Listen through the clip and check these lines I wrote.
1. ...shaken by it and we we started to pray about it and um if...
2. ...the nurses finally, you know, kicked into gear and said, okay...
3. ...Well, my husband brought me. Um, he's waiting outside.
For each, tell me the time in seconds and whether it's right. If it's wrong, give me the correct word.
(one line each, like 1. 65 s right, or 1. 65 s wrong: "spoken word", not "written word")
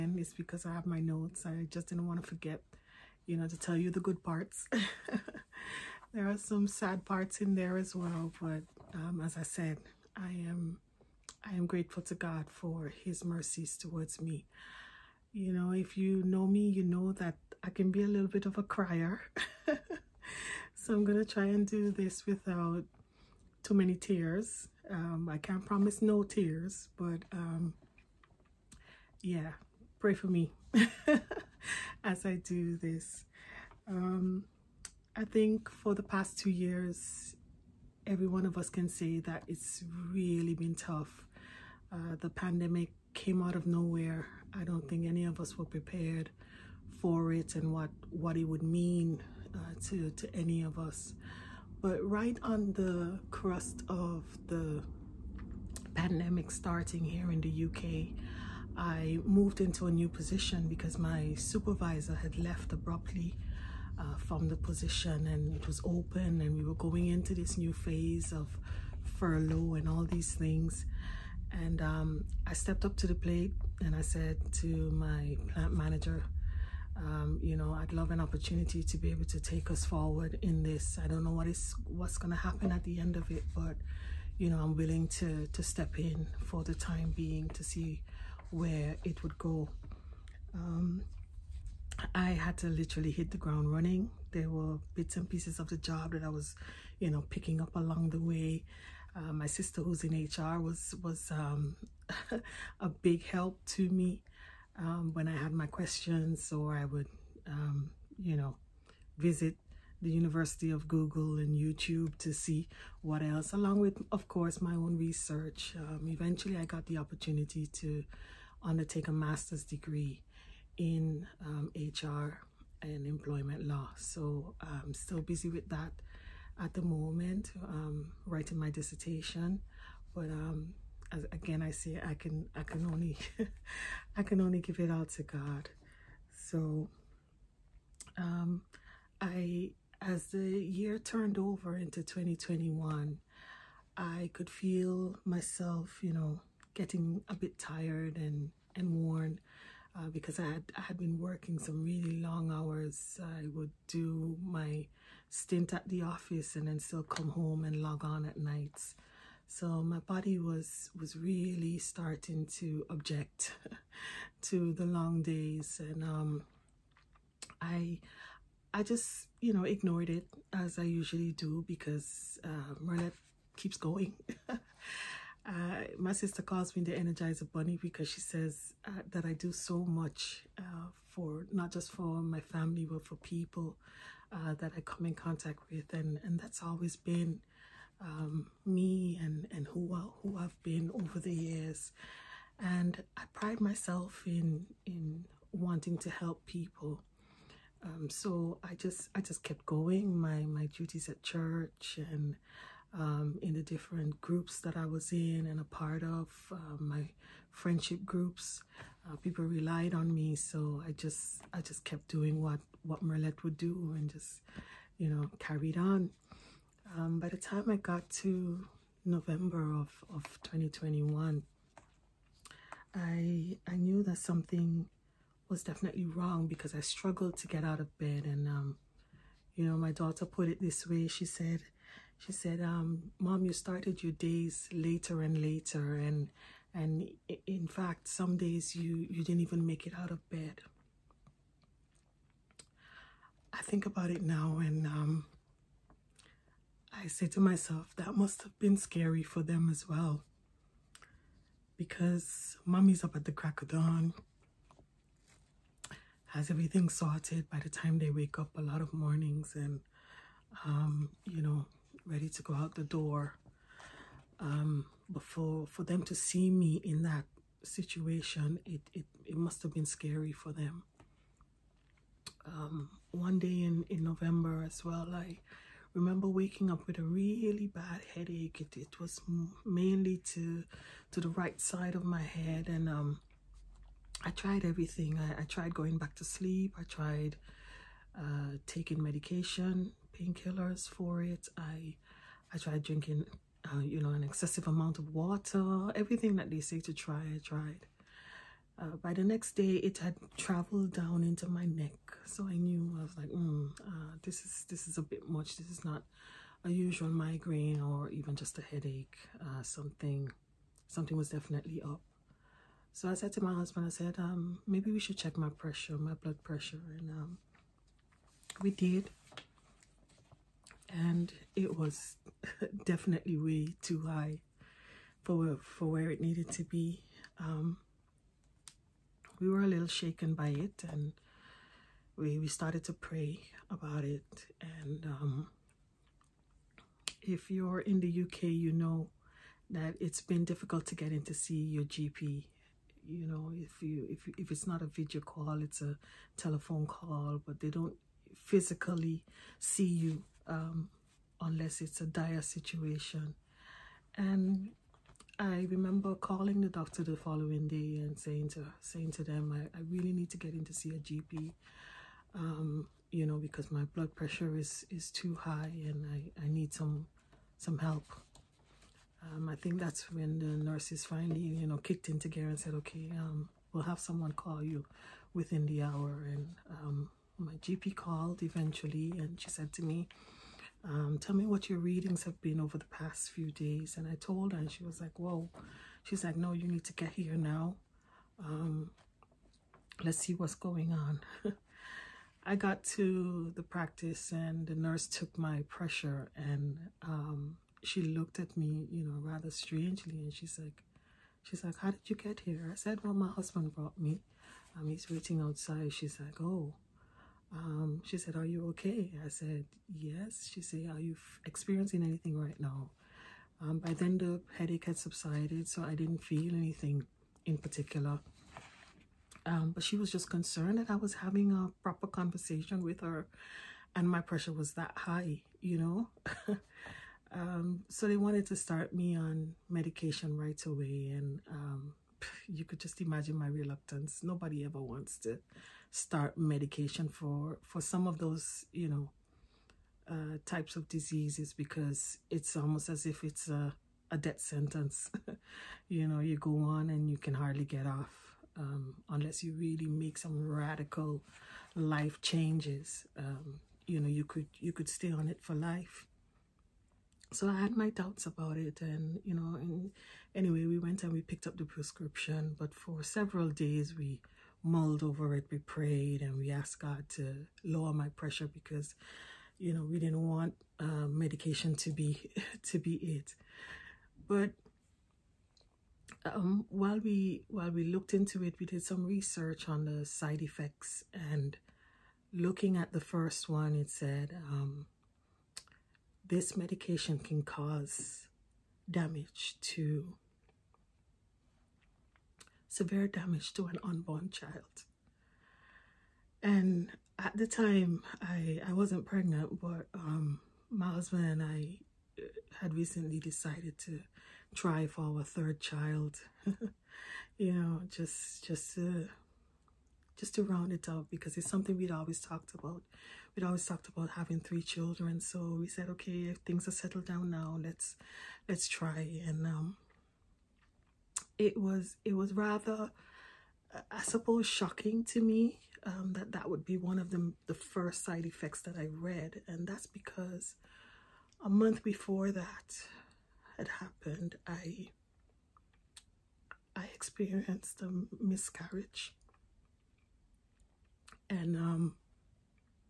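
1. 329 s right
2. 370 s right
3. 403 s right.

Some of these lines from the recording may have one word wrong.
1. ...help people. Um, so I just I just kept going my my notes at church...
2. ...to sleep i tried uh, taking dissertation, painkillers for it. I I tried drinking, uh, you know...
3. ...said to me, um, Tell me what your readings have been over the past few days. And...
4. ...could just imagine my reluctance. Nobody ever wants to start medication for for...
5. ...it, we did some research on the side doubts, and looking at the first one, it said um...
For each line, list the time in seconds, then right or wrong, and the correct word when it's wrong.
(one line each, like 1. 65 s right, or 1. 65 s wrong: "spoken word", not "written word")
1. 196 s wrong: "duties", not "notes"
2. 286 s wrong: "medication", not "dissertation"
3. 379 s right
4. 432 s right
5. 478 s wrong: "effects", not "doubts".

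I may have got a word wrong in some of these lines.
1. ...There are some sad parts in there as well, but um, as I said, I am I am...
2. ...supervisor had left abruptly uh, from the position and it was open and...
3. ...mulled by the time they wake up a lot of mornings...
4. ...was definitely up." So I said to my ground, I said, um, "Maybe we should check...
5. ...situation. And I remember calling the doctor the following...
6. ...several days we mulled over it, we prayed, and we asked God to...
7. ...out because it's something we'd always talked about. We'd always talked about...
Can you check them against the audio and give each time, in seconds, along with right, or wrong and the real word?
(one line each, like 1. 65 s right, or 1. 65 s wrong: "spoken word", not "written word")
1. 6 s right
2. 61 s right
3. 256 s wrong: "sorted", not "mulled"
4. 311 s wrong: "husband", not "ground"
5. 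352 s right
6. 463 s right
7. 510 s right.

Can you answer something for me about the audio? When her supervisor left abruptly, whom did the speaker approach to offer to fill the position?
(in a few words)
Plant manager.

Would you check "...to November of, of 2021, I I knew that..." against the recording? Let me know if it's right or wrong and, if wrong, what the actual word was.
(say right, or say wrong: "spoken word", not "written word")
right.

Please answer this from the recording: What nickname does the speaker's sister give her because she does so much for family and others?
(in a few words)
Energizer Bunny.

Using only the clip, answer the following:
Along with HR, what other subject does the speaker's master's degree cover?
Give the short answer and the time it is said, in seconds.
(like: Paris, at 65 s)
Employment law, at 123 s.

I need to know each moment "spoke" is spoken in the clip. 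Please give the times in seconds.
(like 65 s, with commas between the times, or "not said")
not said.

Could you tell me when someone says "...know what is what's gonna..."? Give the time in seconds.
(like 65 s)
81 s.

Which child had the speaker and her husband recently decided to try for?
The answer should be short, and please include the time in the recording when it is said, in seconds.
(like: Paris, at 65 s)
Third, at 505 s.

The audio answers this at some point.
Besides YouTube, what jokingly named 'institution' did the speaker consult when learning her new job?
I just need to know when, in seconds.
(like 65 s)
110 s.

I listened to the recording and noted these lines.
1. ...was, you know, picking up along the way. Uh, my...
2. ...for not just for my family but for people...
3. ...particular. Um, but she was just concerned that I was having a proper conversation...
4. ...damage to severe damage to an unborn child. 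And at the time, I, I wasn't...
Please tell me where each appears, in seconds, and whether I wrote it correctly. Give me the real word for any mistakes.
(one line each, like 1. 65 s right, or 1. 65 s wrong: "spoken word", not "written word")
1. 96 s right
2. 181 s right
3. 417 s right
4. 488 s right.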